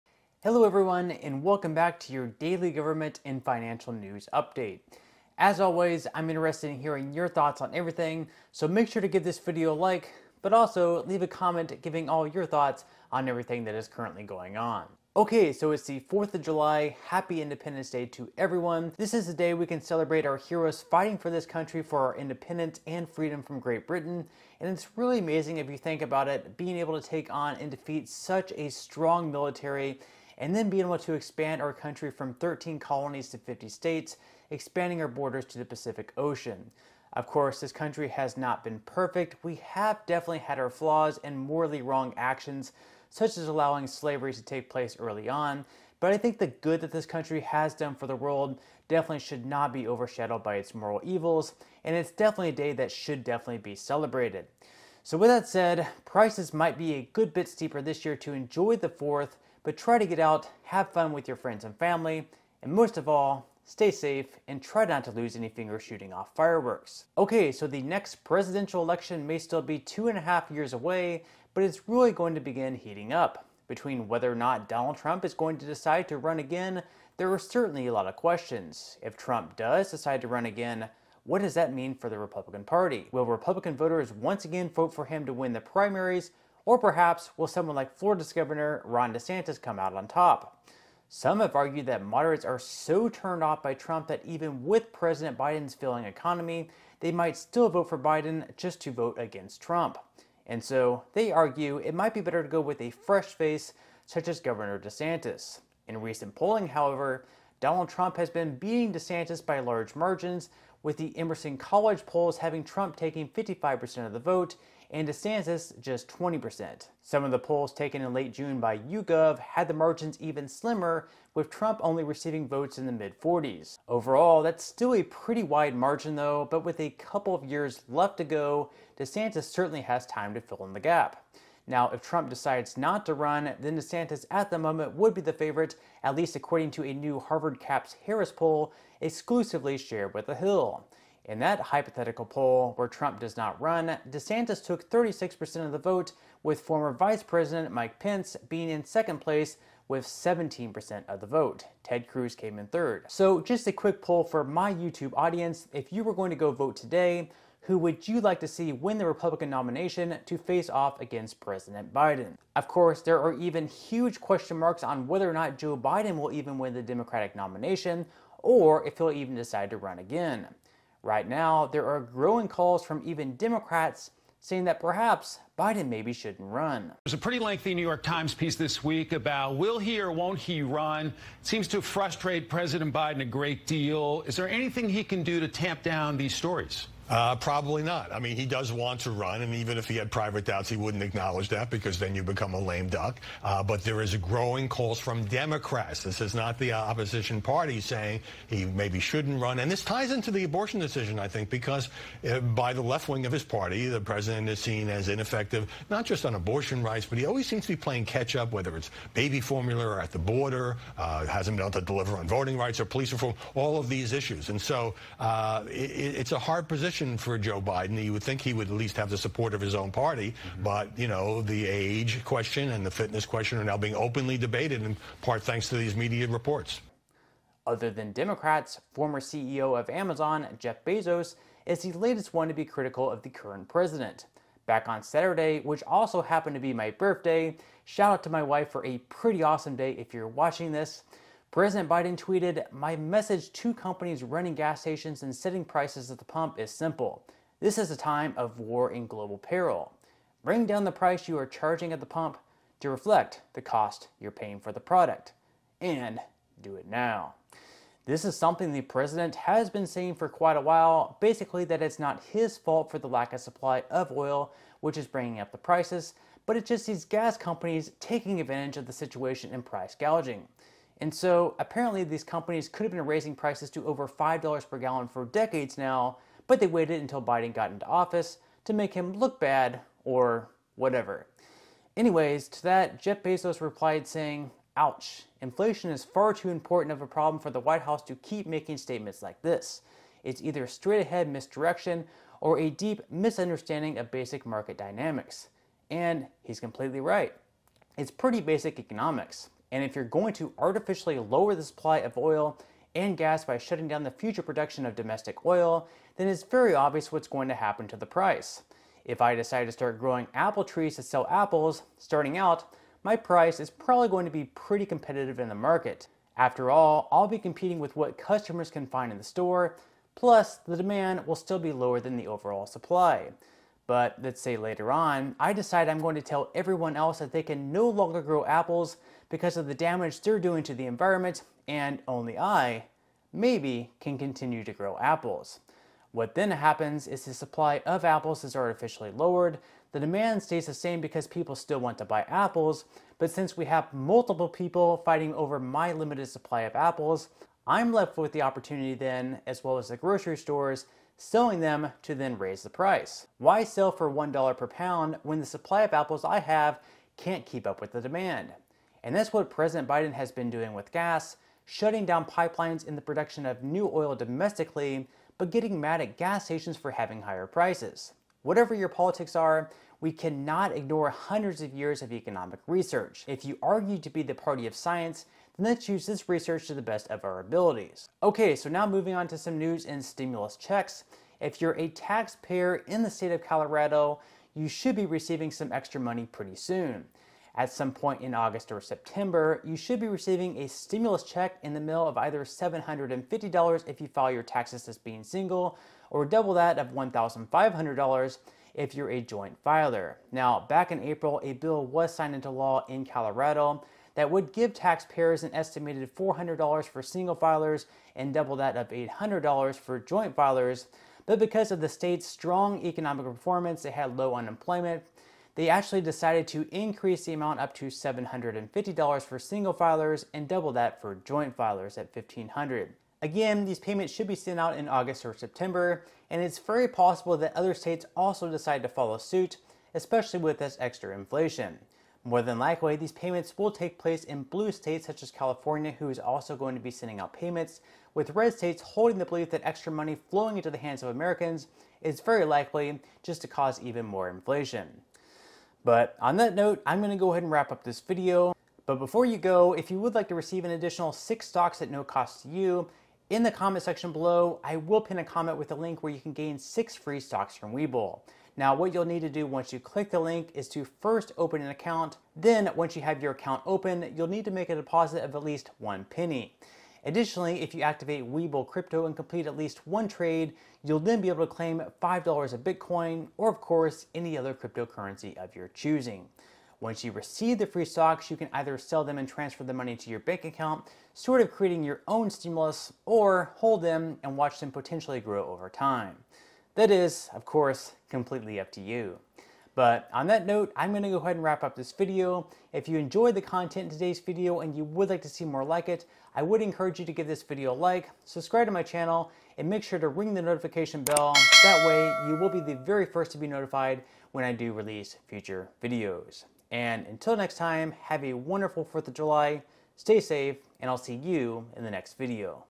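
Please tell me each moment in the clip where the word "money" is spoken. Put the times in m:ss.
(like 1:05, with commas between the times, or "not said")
6:26, 7:19, 7:59.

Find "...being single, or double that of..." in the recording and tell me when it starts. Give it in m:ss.
6:34.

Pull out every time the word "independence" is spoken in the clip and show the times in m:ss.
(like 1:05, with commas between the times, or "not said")
0:17, 0:22.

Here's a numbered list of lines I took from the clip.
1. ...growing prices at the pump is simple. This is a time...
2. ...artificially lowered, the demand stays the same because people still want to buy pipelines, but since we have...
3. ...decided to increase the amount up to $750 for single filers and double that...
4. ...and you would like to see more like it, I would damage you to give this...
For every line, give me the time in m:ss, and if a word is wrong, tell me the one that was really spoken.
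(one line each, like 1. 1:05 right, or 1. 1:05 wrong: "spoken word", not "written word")
1. 4:05 wrong: "setting", not "growing"
2. 5:38 wrong: "apples", not "pipelines"
3. 6:56 right
4. 8:14 wrong: "encourage", not "damage".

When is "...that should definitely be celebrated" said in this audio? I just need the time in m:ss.
0:52.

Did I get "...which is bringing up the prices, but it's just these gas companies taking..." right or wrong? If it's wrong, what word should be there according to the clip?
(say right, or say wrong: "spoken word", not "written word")
right.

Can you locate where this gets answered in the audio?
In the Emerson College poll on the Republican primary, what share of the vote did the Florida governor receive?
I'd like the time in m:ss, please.
1:56.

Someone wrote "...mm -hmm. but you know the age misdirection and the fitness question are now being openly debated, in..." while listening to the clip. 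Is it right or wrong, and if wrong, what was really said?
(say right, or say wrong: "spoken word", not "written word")
wrong: "question", not "misdirection".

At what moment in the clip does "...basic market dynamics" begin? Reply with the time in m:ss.
4:54.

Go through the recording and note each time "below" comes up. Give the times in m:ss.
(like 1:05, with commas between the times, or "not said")
7:34.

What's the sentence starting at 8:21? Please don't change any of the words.
That way, you will be the very first to be notified when I do release future videos.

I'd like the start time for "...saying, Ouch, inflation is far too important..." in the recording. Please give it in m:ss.
4:44.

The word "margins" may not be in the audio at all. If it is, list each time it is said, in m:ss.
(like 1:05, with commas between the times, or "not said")
1:49, 1:59, 2:05.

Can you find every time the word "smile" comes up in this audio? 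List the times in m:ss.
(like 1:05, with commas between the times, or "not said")
not said.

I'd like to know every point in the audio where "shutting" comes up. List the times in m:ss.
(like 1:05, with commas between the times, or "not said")
5:03, 6:01.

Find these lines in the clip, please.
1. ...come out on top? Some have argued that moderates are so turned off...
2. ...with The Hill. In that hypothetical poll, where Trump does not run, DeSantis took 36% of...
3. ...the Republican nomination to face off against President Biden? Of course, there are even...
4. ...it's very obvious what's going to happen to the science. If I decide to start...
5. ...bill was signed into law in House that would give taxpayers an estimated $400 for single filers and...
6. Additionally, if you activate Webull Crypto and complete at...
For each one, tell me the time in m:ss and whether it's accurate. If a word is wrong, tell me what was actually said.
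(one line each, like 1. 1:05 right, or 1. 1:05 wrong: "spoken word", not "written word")
1. 1:29 right
2. 2:20 right
3. 2:38 right
4. 5:06 wrong: "price", not "science"
5. 6:41 wrong: "Colorado", not "House"
6. 7:47 right.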